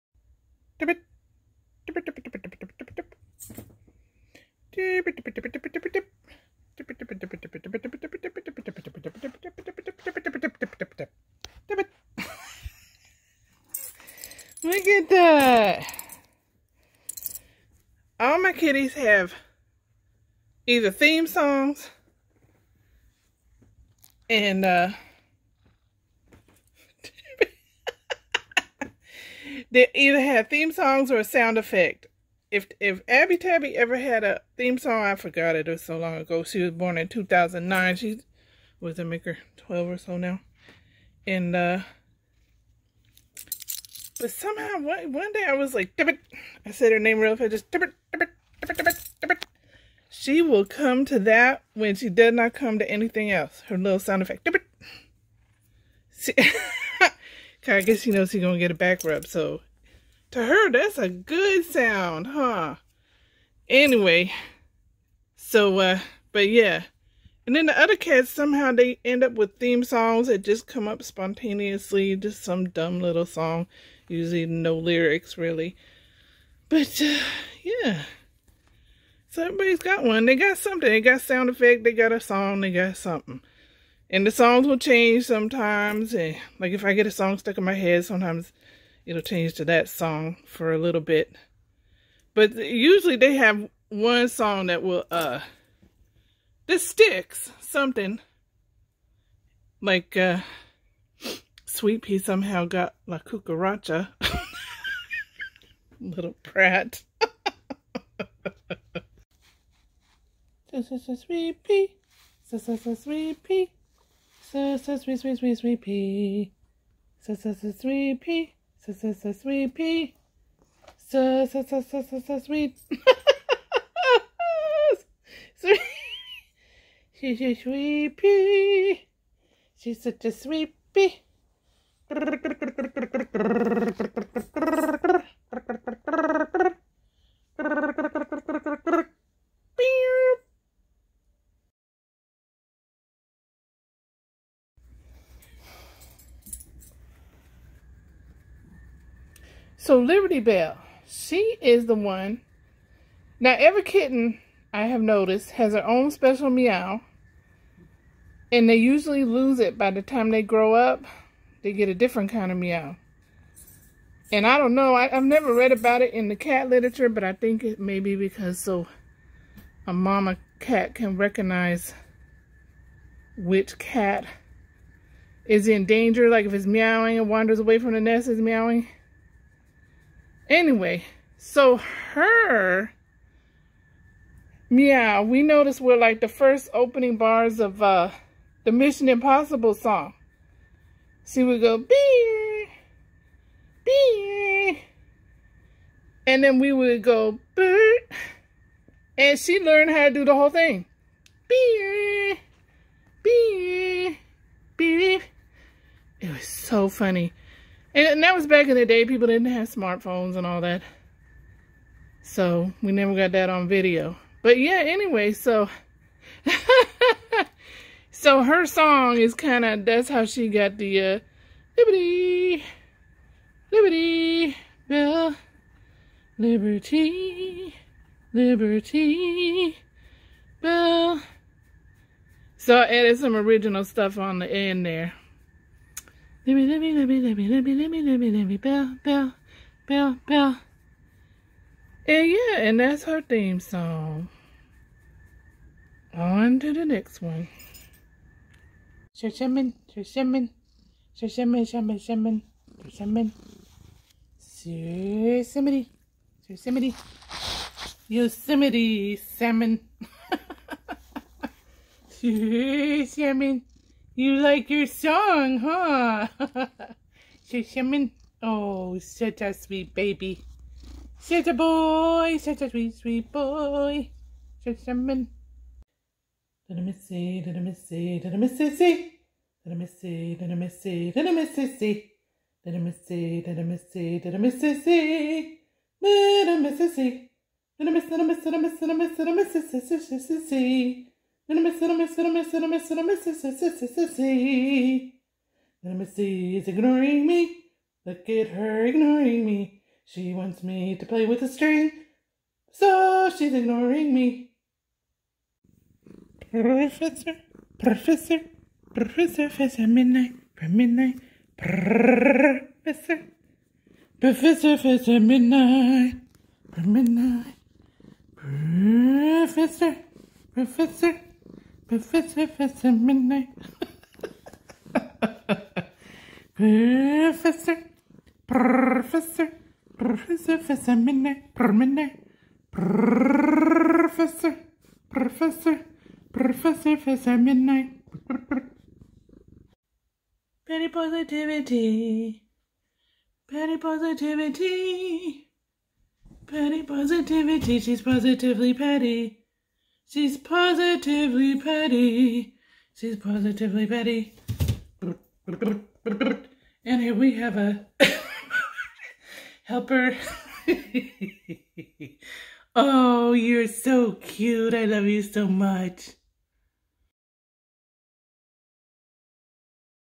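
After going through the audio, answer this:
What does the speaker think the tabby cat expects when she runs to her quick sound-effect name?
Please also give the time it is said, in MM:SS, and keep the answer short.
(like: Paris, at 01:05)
A back rub, at 00:58.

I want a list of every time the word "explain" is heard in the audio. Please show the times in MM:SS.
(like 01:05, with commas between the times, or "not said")
not said.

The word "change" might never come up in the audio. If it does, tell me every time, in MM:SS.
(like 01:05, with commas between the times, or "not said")
01:24, 01:29.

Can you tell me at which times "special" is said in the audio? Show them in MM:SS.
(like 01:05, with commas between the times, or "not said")
02:36.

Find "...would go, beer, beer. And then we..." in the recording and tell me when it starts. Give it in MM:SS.
03:11.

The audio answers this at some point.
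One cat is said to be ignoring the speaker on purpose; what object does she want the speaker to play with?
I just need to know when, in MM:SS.
05:01.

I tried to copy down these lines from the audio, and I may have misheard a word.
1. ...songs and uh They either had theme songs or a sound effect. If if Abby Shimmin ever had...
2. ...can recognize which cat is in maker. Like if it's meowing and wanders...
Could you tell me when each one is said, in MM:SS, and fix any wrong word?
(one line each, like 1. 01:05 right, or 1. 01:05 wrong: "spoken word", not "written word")
1. 00:21 wrong: "Tabby", not "Shimmin"
2. 02:50 wrong: "danger", not "maker".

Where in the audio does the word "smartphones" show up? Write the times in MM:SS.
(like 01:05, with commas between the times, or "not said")
03:29.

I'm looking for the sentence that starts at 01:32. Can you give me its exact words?
But usually they have one song that will, uh, this sticks something.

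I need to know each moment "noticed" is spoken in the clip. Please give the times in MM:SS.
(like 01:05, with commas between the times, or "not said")
02:35, 03:05.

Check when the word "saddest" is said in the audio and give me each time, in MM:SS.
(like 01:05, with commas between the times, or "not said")
not said.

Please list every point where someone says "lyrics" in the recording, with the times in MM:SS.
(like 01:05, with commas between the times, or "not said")
01:14.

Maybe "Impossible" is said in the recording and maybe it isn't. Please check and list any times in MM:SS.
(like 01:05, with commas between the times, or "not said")
03:09.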